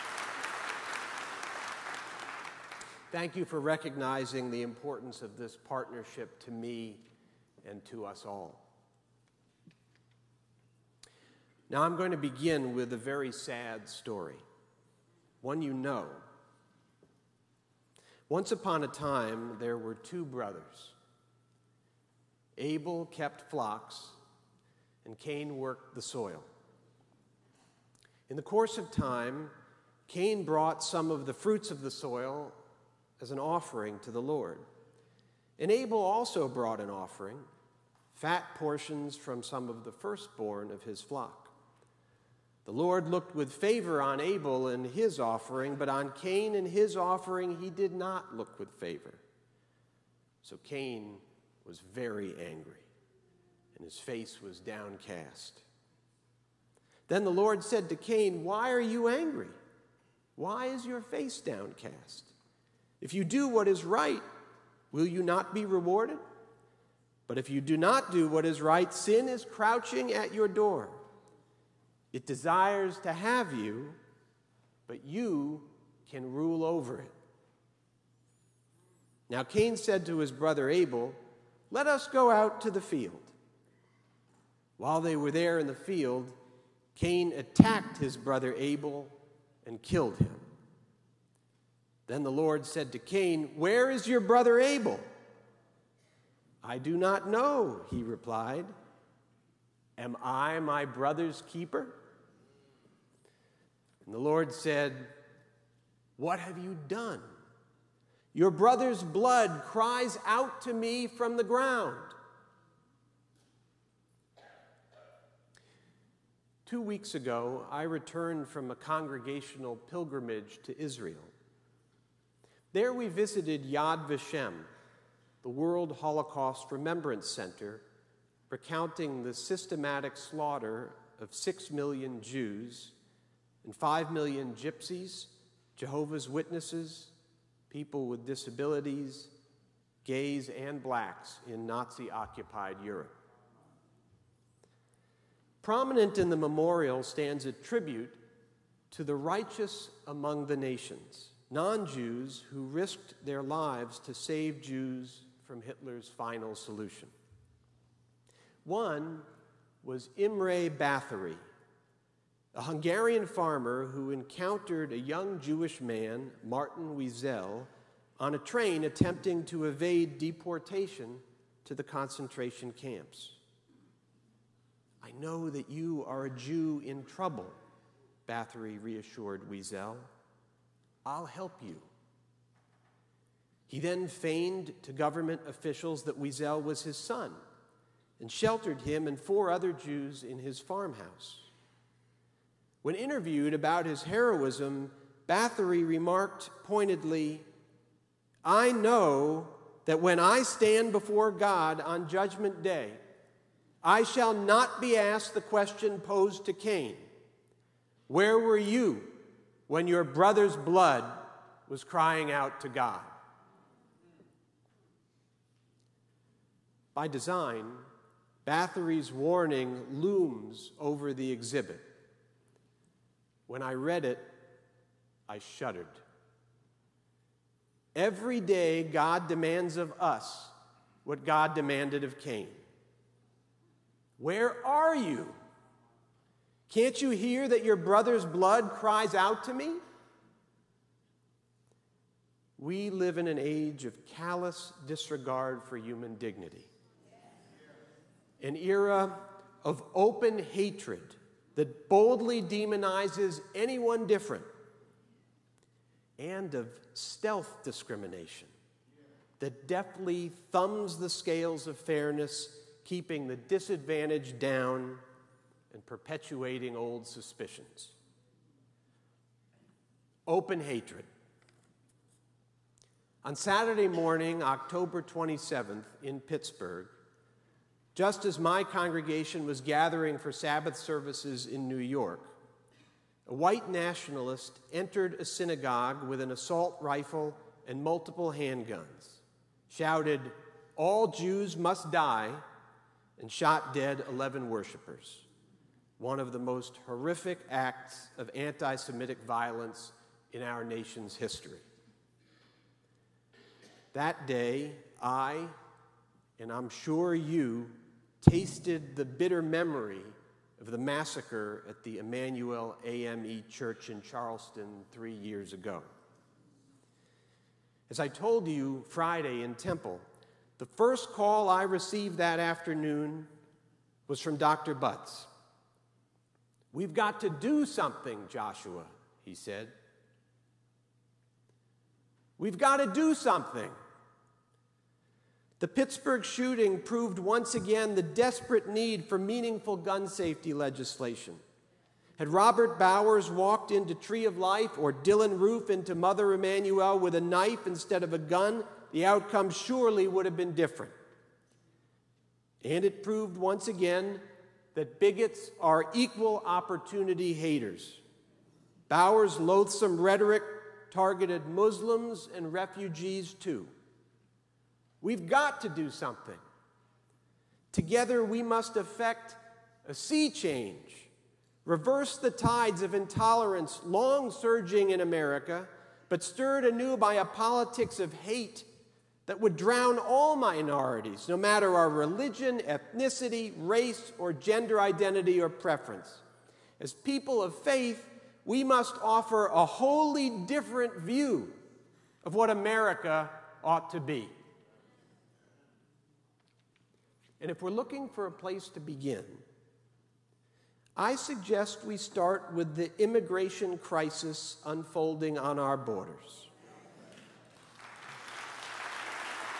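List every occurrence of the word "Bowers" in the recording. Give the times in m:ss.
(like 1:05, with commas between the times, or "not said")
5:42, 5:58.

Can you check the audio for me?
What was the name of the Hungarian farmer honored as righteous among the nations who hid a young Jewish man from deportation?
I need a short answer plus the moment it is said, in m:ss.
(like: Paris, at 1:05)
Imre Bathory, at 2:40.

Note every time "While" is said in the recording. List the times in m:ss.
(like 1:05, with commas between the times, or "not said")
1:24.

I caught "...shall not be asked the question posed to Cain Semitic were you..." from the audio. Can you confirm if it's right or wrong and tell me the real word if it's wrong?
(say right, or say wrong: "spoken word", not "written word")
wrong: "Where", not "Semitic".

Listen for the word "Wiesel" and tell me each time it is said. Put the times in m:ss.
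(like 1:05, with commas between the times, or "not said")
2:46, 2:59, 3:06.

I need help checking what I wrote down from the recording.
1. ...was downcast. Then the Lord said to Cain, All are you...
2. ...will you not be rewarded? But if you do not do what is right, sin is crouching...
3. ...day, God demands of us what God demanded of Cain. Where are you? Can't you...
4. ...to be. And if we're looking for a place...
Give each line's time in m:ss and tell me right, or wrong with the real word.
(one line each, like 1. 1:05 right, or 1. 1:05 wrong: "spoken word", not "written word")
1. 0:54 wrong: "Why", not "All"
2. 1:04 right
3. 3:48 right
4. 6:33 right.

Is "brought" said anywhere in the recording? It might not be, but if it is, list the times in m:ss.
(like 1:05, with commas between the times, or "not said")
0:30, 0:36.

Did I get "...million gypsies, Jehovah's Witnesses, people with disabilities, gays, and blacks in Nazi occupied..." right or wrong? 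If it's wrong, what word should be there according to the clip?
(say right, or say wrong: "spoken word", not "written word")
right.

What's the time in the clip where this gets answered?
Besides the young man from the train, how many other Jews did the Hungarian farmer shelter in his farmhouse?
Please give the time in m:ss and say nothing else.
3:09.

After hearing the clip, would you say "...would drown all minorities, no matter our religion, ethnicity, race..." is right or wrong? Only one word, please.
right.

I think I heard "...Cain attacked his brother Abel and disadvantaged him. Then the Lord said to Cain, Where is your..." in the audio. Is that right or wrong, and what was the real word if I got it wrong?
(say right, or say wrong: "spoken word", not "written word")
wrong: "killed", not "disadvantaged".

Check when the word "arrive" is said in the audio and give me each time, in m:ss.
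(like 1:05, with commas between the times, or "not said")
not said.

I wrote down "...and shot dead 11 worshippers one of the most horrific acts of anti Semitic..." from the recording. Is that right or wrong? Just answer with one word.
right.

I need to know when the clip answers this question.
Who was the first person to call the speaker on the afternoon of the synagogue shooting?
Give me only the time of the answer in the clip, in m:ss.
5:24.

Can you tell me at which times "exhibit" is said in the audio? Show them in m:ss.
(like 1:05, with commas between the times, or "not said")
3:41.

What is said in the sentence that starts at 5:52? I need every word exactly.
And it proved once again that bigots are equal opportunity haters.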